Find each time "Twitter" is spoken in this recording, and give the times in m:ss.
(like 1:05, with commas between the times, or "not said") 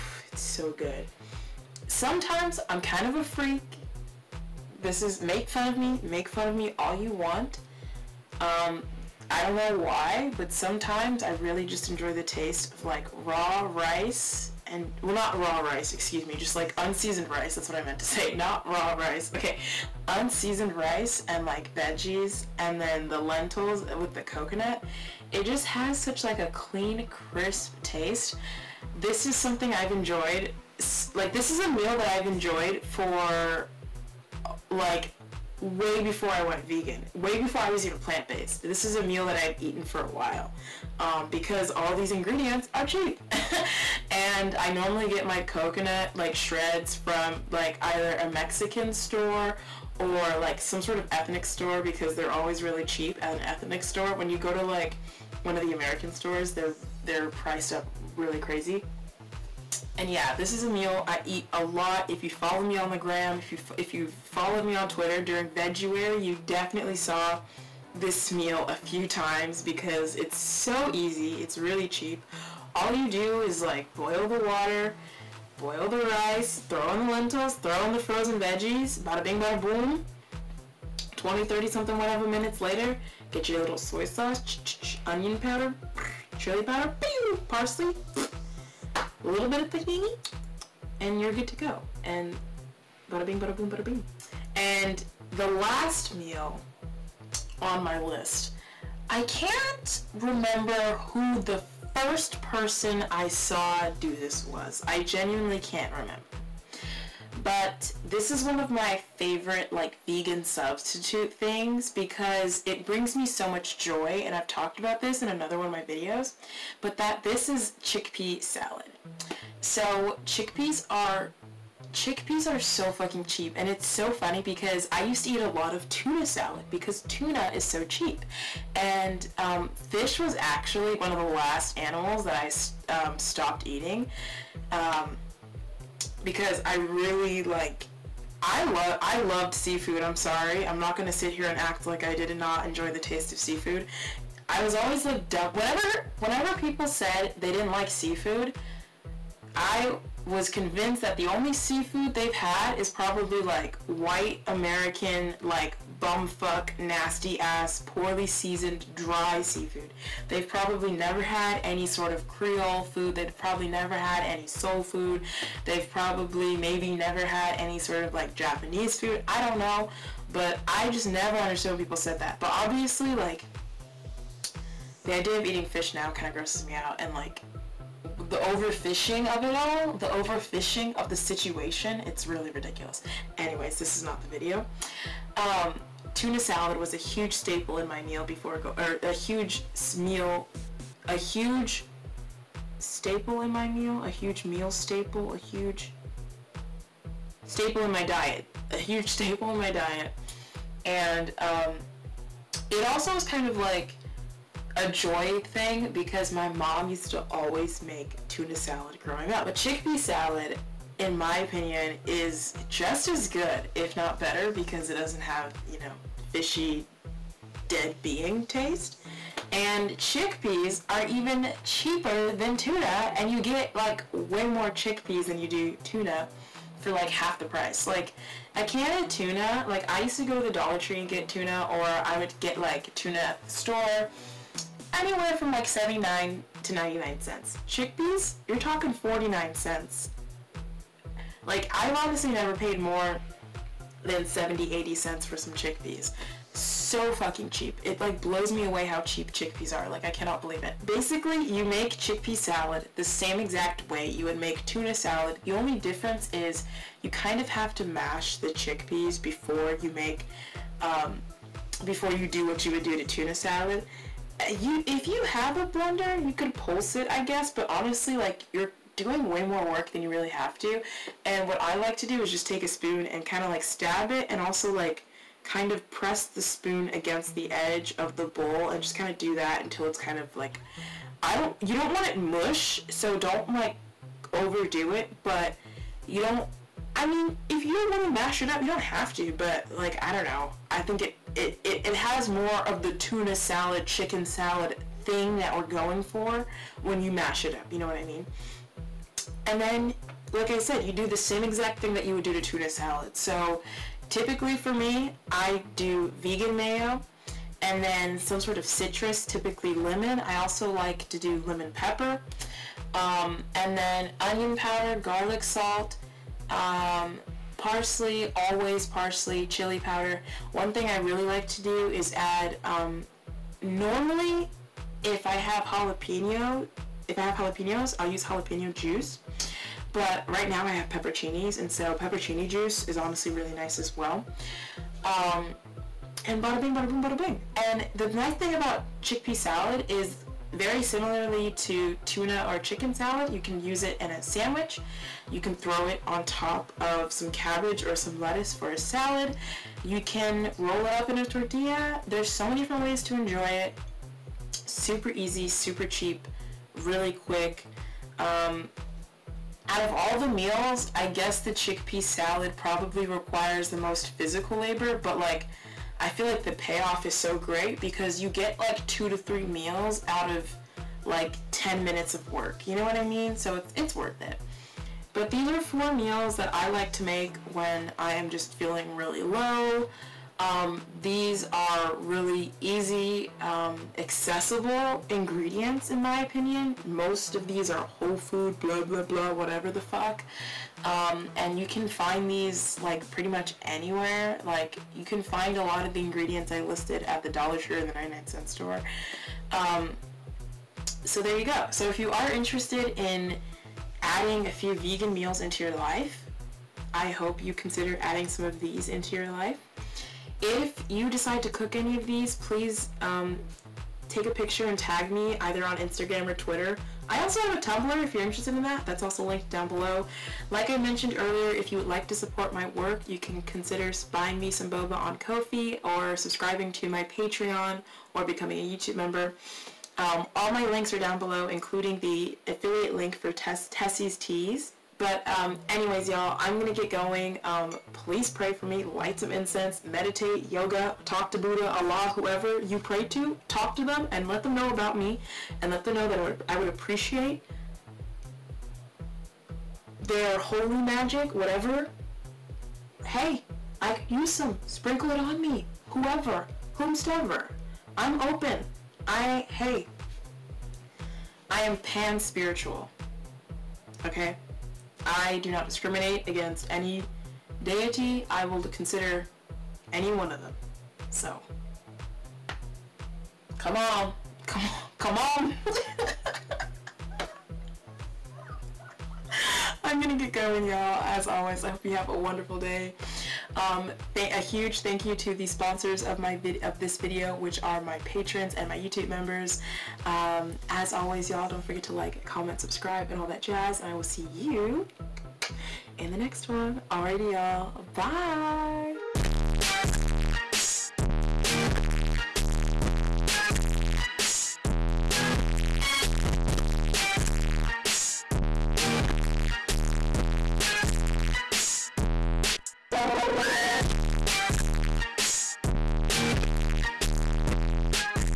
1:04, 6:56.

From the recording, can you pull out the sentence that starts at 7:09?
Um, all my links are down below, including the affiliate link for Tess Tessie's Teas.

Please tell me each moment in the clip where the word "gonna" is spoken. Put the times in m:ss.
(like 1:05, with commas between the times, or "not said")
2:20, 7:59.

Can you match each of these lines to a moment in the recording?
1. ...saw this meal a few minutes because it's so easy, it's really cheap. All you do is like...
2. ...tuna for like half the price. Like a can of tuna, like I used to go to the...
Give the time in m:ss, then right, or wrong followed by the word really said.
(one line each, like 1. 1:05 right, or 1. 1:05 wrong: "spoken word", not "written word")
1. 1:06 wrong: "times", not "minutes"
2. 3:45 right.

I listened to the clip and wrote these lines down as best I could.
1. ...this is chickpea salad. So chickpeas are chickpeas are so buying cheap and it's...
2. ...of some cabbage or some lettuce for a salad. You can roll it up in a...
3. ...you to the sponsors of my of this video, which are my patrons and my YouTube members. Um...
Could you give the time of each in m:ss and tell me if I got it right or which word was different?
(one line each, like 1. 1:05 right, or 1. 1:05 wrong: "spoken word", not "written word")
1. 1:57 wrong: "fucking", not "buying"
2. 5:46 right
3. 8:05 right.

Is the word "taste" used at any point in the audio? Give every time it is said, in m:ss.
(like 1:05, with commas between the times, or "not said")
0:12, 0:27, 2:22, 3:38.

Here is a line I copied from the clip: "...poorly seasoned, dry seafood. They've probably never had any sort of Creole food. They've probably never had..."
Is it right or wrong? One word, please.
right.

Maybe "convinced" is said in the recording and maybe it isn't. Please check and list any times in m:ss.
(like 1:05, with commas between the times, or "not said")
2:30.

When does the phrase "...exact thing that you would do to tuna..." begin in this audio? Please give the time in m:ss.
5:01.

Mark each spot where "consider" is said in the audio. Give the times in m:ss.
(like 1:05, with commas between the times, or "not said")
6:47, 7:03, 7:48.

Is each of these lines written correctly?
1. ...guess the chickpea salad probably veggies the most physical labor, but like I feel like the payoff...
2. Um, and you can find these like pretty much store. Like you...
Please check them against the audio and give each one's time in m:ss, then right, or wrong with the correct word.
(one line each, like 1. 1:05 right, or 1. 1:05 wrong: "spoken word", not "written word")
1. 6:01 wrong: "requires", not "veggies"
2. 6:30 wrong: "anywhere", not "store".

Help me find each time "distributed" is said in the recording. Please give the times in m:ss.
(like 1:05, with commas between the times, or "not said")
not said.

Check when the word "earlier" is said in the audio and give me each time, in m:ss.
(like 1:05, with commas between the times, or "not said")
7:01.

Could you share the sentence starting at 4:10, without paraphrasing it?
Basically, you make chickpea salad the same exact way you would make tuna salad.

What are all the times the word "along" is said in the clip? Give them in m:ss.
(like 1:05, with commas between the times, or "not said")
not said.